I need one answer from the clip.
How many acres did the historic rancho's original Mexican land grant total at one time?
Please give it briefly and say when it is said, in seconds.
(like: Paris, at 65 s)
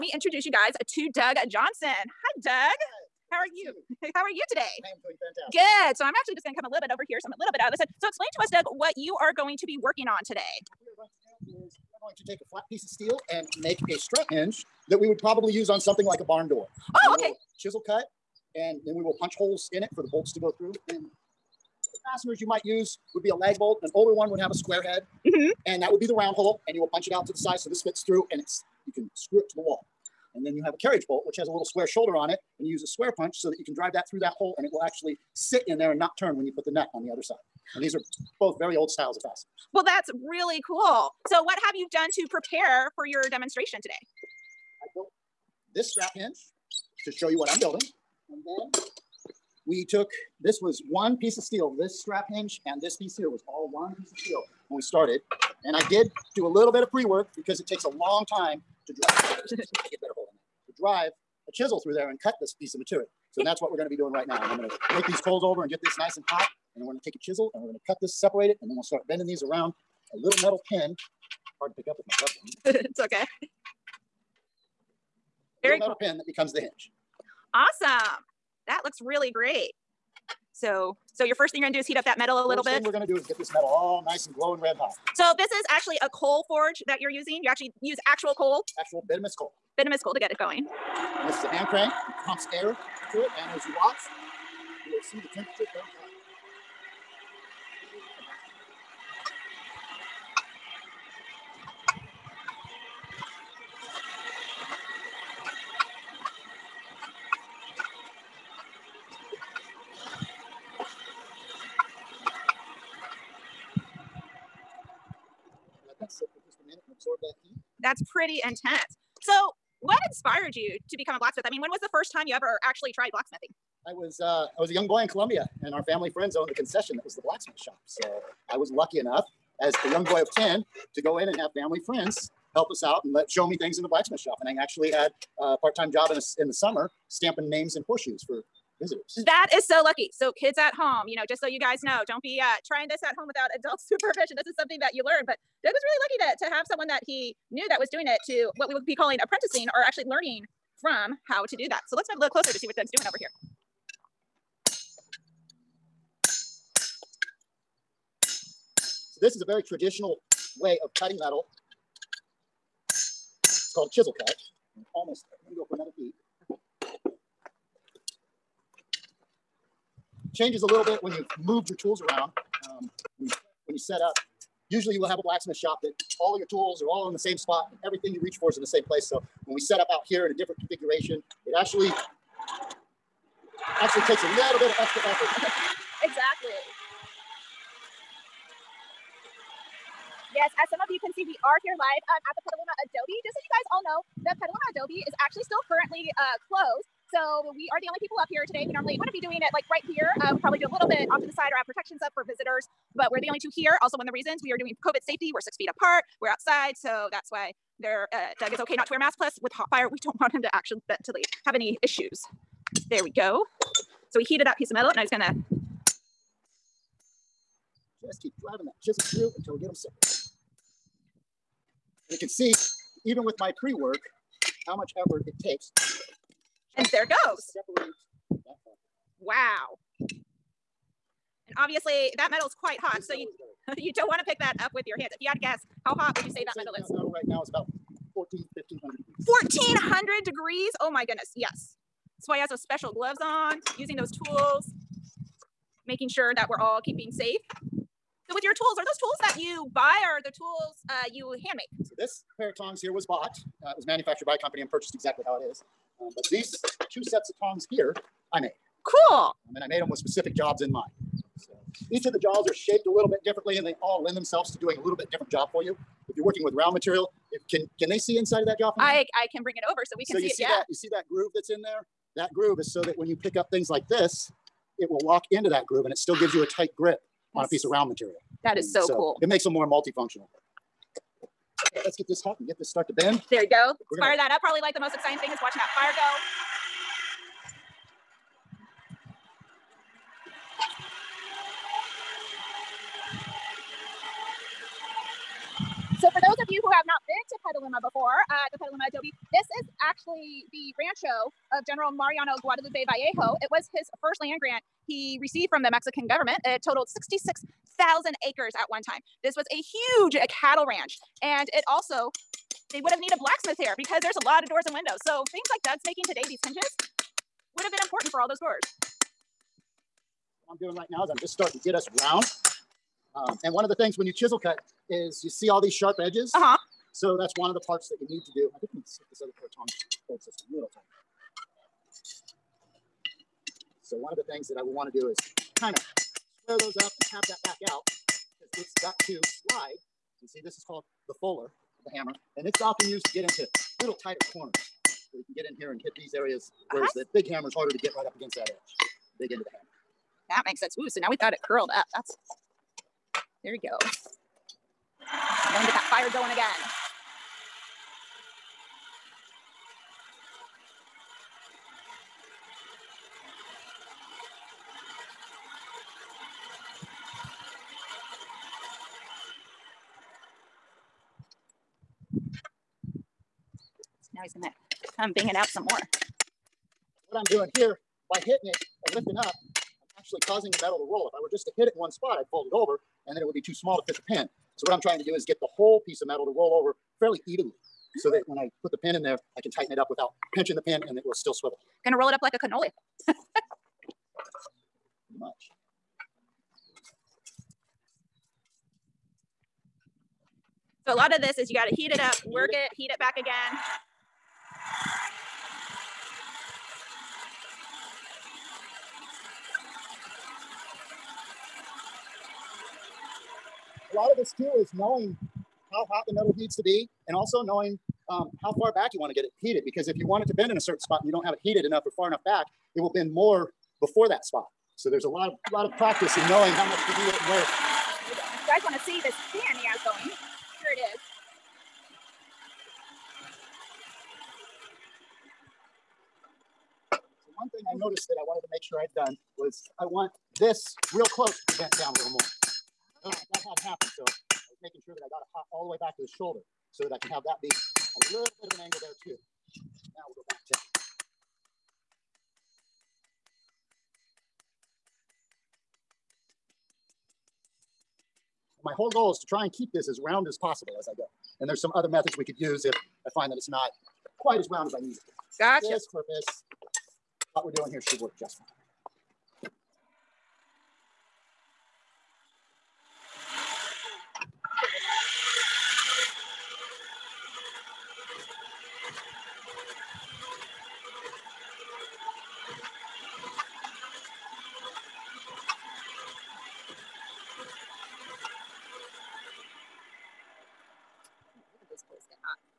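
66,000 acres, at 306 s.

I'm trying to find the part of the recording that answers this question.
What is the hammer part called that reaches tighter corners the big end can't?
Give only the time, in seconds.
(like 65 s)
341 s.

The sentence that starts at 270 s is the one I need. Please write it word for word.
That, you see that groove that's in there?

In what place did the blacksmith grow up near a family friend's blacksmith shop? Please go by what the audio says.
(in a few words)
Columbia.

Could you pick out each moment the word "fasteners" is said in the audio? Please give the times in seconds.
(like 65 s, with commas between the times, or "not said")
22 s, 39 s.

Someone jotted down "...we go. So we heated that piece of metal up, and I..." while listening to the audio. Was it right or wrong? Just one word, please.
right.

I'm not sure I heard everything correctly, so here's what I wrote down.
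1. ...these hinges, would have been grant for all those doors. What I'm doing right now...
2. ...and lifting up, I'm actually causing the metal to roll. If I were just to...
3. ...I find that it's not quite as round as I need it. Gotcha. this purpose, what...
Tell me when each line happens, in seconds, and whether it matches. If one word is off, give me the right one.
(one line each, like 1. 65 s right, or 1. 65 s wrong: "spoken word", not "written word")
1. 316 s wrong: "important", not "grant"
2. 378 s right
3. 463 s right.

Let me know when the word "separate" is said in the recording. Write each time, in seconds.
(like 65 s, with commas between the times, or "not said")
68 s, 219 s.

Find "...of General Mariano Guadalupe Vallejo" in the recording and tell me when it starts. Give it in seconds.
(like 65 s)
301 s.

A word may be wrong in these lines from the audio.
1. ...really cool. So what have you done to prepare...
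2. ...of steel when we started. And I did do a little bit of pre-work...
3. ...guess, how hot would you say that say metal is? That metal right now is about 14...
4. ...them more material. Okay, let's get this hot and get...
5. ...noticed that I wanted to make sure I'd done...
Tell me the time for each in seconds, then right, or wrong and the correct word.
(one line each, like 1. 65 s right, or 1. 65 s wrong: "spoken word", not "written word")
1. 40 s right
2. 54 s right
3. 235 s right
4. 279 s wrong: "multifunctional", not "material"
5. 437 s right.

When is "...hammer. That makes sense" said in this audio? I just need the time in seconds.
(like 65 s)
349 s.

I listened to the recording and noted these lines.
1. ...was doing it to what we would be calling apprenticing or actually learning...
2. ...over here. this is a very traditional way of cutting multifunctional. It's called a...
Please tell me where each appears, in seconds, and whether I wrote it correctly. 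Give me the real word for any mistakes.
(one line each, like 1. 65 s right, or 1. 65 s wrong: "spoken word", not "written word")
1. 147 s right
2. 153 s wrong: "metal", not "multifunctional".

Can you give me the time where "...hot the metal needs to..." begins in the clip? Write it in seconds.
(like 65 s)
415 s.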